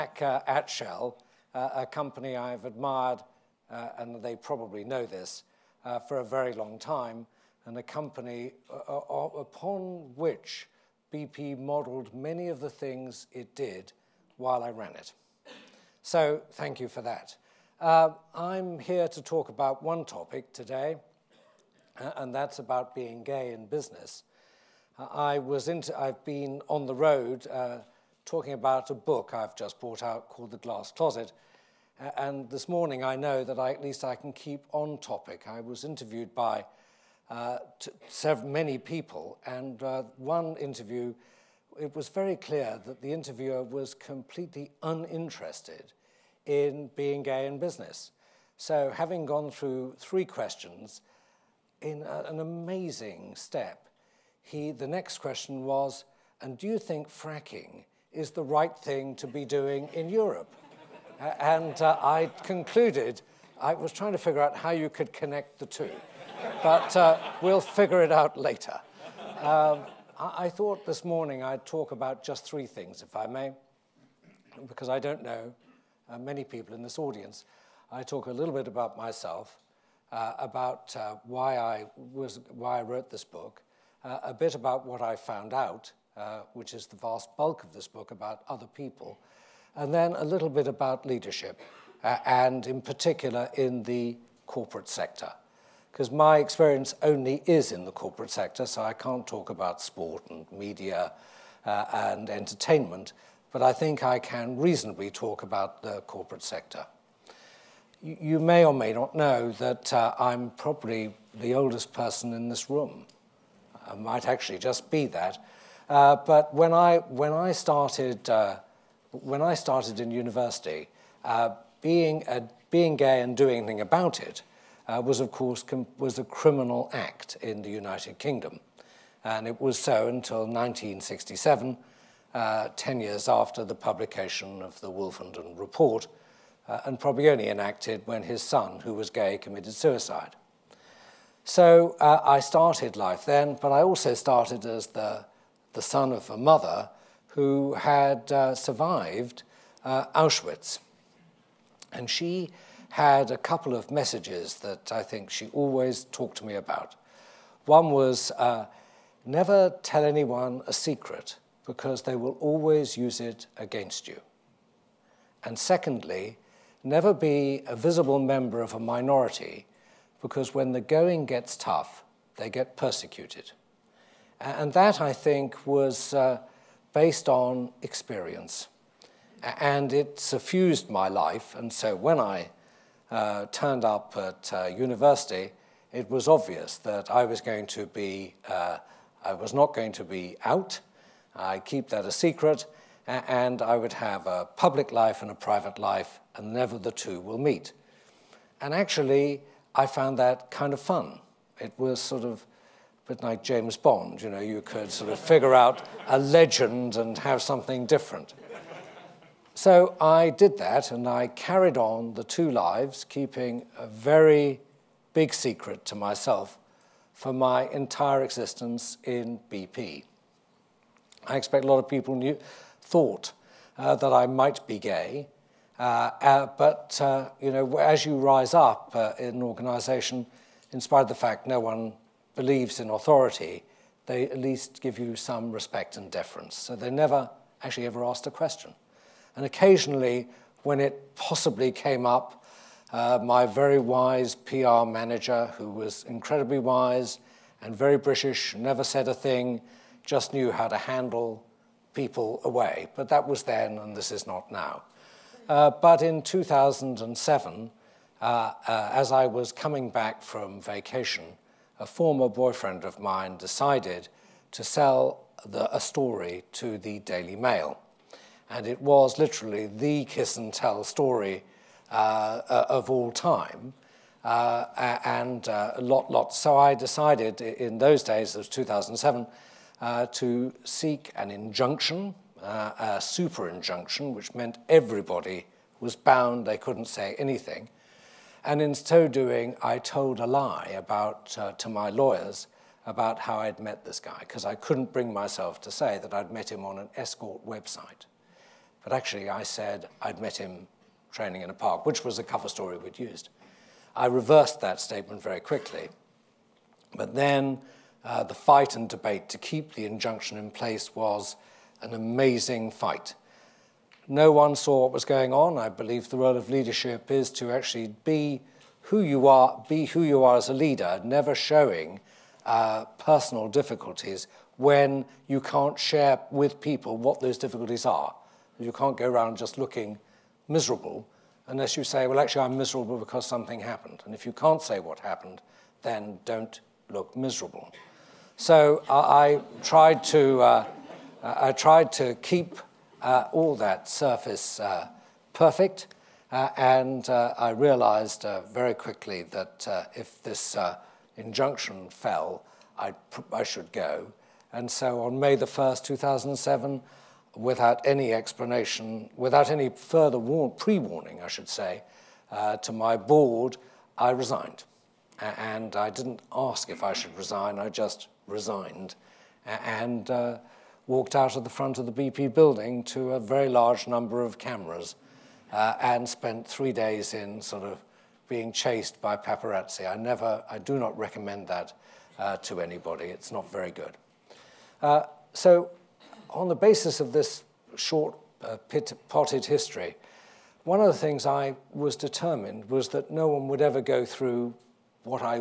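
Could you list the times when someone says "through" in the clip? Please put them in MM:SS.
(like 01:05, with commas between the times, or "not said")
00:49, 06:34.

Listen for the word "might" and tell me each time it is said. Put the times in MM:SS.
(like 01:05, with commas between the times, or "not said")
01:53, 03:44.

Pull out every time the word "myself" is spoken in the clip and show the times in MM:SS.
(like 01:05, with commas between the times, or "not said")
01:18, 03:35, 04:55.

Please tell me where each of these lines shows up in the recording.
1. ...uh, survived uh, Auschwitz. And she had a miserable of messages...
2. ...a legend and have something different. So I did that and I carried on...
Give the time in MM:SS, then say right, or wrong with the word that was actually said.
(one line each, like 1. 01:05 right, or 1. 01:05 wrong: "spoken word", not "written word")
1. 02:28 wrong: "couple", not "miserable"
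2. 03:26 right.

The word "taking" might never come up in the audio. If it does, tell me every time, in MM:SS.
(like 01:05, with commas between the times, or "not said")
not said.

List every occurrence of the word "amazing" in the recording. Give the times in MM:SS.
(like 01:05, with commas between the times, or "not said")
00:52, 05:11.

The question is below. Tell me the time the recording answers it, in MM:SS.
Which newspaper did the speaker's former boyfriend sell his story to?
04:26.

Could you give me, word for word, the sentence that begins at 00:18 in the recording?
I'm here to talk about one topic today, and that's about being gay in business.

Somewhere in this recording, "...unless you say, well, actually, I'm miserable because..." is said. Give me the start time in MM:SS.
05:31.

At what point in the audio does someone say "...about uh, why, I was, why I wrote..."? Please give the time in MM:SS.
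01:20.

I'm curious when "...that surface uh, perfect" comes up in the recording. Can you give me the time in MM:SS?
05:43.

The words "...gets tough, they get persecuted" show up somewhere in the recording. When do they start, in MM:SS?
02:51.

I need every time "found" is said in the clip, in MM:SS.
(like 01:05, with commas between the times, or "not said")
01:25, 03:19.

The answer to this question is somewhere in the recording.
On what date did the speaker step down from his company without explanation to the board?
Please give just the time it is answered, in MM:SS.
05:55.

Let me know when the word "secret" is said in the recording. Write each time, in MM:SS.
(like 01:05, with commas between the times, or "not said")
02:40, 03:12, 03:35.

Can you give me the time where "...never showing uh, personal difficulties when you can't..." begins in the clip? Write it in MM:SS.
05:21.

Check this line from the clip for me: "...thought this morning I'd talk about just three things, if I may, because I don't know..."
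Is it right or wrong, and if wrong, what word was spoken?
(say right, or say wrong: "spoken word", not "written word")
right.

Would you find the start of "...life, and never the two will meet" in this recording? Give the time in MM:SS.
03:15.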